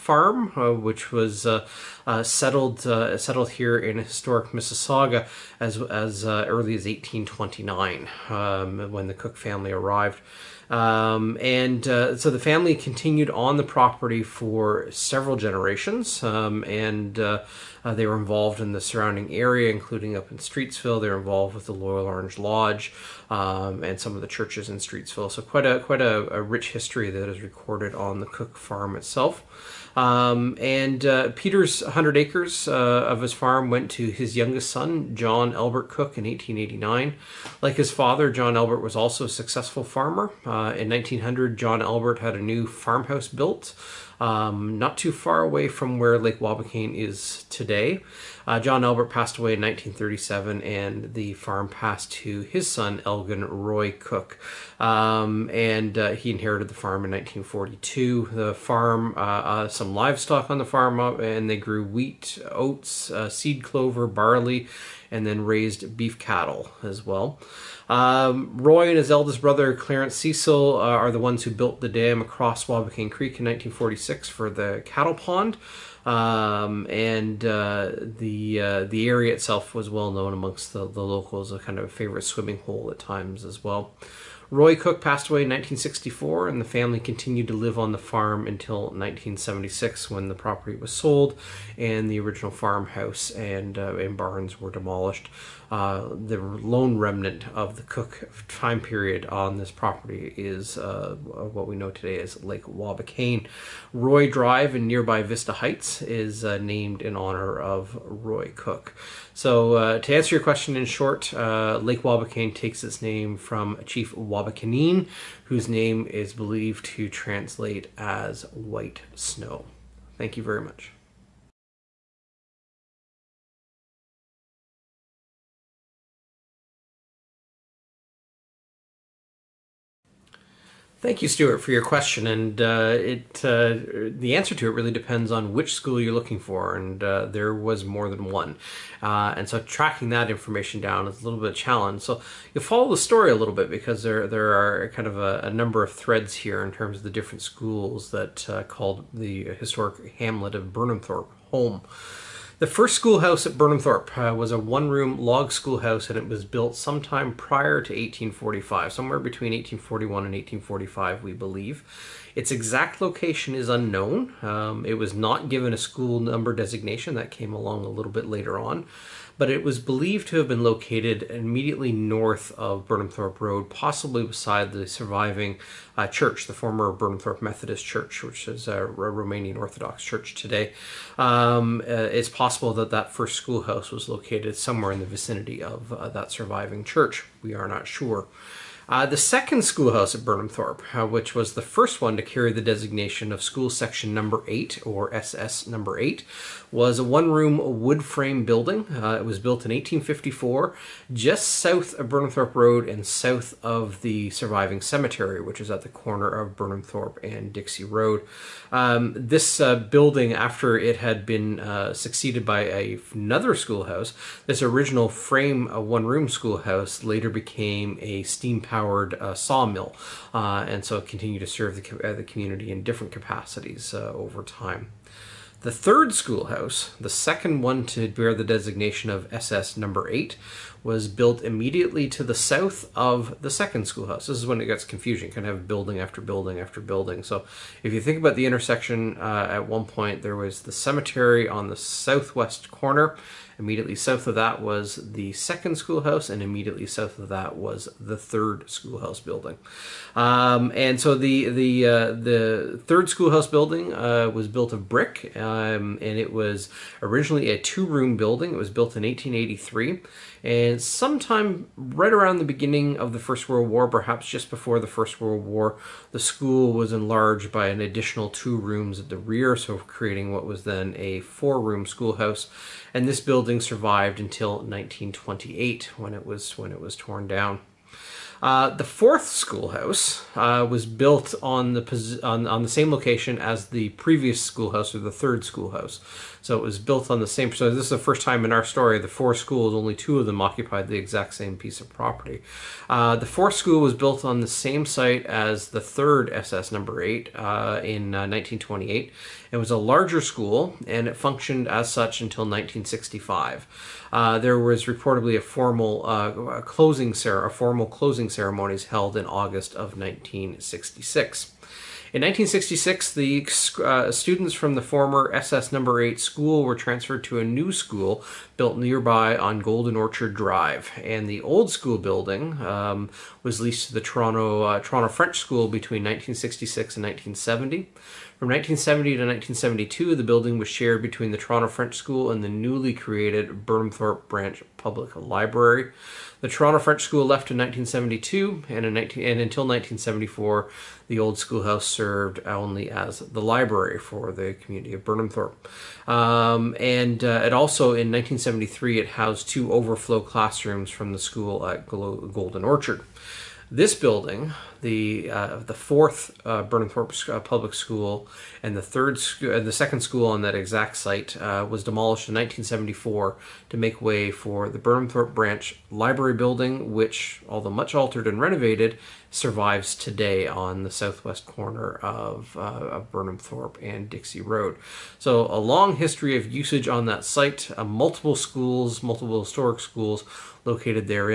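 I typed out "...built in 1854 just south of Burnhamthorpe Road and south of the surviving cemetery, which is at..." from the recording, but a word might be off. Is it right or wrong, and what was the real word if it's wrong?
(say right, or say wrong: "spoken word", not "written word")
right.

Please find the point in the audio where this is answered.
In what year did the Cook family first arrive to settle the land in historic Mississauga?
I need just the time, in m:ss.
0:06.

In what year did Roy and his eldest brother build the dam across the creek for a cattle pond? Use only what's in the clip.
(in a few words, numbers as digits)
1946.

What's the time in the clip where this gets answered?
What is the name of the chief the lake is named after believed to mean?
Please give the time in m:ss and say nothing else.
1:58.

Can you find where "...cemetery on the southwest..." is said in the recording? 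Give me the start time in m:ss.
4:00.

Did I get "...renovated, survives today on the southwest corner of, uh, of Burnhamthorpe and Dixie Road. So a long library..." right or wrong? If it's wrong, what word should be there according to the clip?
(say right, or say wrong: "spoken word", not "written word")
wrong: "history", not "library".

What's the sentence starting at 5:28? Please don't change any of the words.
From 1970 to 1972, the building was shared between the Toronto French School and the newly created Burnhamthorpe Branch Public Library.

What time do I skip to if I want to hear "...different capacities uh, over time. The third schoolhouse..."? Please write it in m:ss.
3:42.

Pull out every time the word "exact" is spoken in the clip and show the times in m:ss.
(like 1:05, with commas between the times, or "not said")
2:42, 4:50, 6:00.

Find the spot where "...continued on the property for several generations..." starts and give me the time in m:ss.
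0:12.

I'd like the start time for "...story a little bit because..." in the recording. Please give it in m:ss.
2:22.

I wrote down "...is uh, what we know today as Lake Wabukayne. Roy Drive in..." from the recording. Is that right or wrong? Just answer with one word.
right.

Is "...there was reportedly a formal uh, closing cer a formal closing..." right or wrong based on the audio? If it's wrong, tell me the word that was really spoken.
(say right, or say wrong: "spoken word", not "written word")
right.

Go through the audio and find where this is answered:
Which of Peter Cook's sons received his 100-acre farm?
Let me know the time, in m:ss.
0:35.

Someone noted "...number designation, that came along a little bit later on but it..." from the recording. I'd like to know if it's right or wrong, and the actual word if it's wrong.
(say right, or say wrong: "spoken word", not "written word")
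right.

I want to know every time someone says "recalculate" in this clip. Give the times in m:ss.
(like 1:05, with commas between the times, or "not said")
not said.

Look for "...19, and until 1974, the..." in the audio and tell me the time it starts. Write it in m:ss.
5:38.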